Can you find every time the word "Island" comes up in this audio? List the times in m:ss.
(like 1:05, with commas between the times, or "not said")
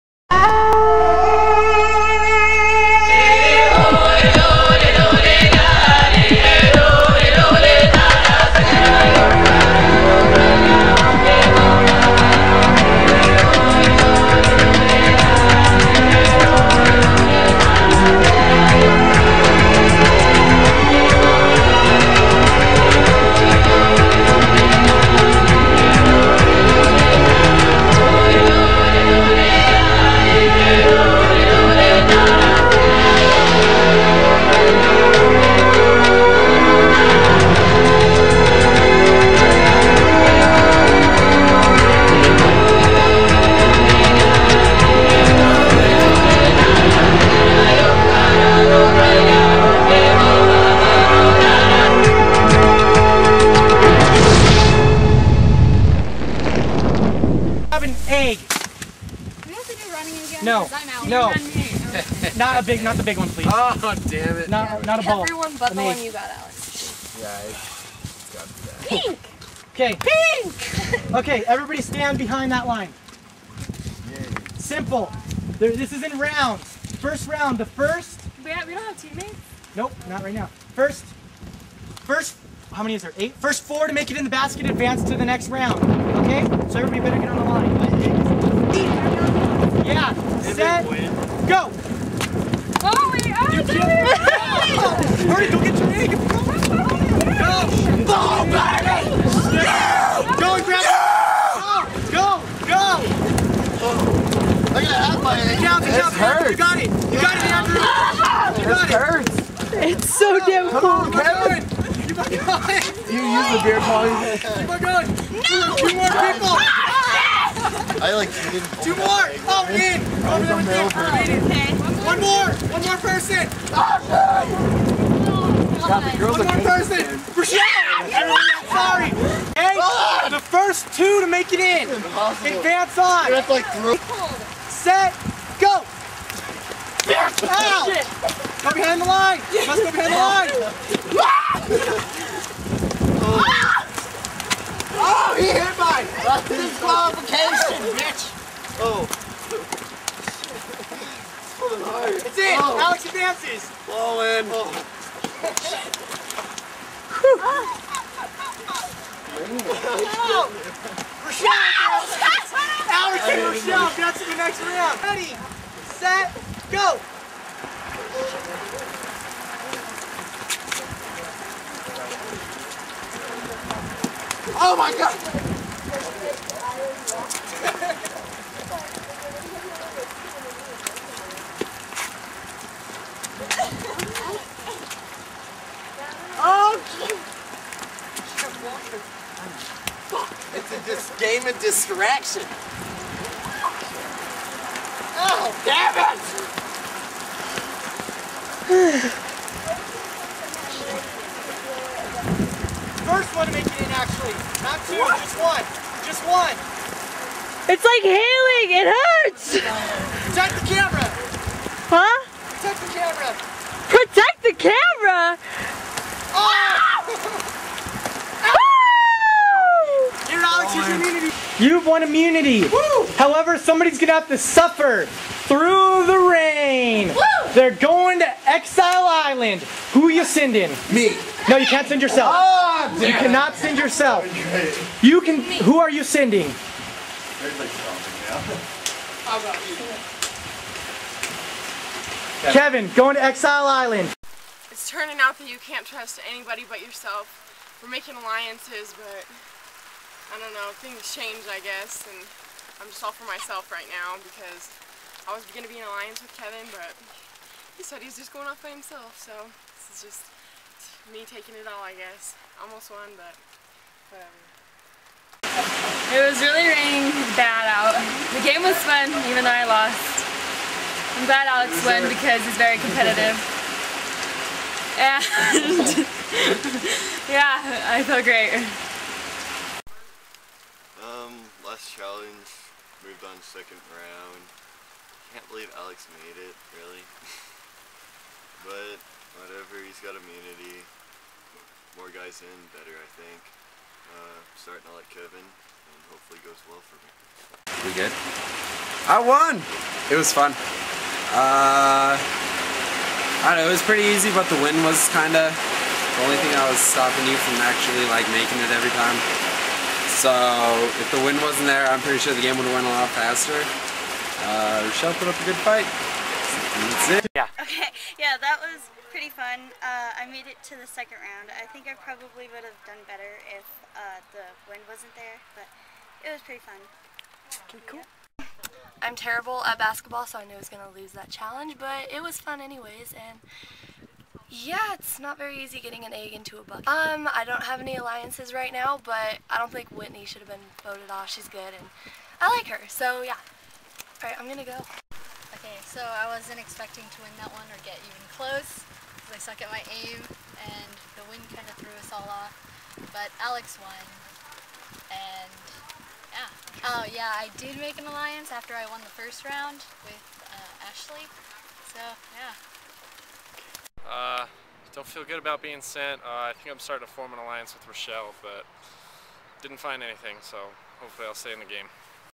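3:49, 4:03.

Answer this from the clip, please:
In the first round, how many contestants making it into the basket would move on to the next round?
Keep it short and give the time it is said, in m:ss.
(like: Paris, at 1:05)
4, at 1:23.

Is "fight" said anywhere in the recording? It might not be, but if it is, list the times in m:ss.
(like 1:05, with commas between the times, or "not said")
5:15.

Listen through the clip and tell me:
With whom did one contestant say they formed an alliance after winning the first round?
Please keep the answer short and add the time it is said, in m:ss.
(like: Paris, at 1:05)
Ashley, at 6:00.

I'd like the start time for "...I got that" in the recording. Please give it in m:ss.
1:07.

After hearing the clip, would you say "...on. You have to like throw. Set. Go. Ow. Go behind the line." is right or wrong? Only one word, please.
right.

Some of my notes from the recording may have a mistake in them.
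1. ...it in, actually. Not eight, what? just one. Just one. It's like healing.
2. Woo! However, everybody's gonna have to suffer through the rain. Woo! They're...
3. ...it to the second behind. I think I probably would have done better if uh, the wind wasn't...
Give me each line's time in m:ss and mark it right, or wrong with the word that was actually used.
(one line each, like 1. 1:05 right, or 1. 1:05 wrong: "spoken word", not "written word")
1. 3:23 wrong: "two", not "eight"
2. 3:42 wrong: "somebody", not "everybody"
3. 5:20 wrong: "round", not "behind".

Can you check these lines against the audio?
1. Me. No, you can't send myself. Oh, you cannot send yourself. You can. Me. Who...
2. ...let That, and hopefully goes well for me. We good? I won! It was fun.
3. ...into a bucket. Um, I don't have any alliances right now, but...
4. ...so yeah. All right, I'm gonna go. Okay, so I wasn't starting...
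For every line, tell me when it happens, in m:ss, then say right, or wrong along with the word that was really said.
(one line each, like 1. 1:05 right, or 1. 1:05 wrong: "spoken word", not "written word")
1. 3:50 wrong: "yourself", not "myself"
2. 4:54 wrong: "Kevin", not "That"
3. 5:36 right
4. 5:42 wrong: "expecting", not "starting".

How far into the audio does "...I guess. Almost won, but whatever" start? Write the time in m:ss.
4:21.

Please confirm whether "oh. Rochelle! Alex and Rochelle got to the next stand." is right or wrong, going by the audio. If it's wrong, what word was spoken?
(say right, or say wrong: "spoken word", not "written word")
wrong: "round", not "stand".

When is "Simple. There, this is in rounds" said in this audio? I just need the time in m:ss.
1:14.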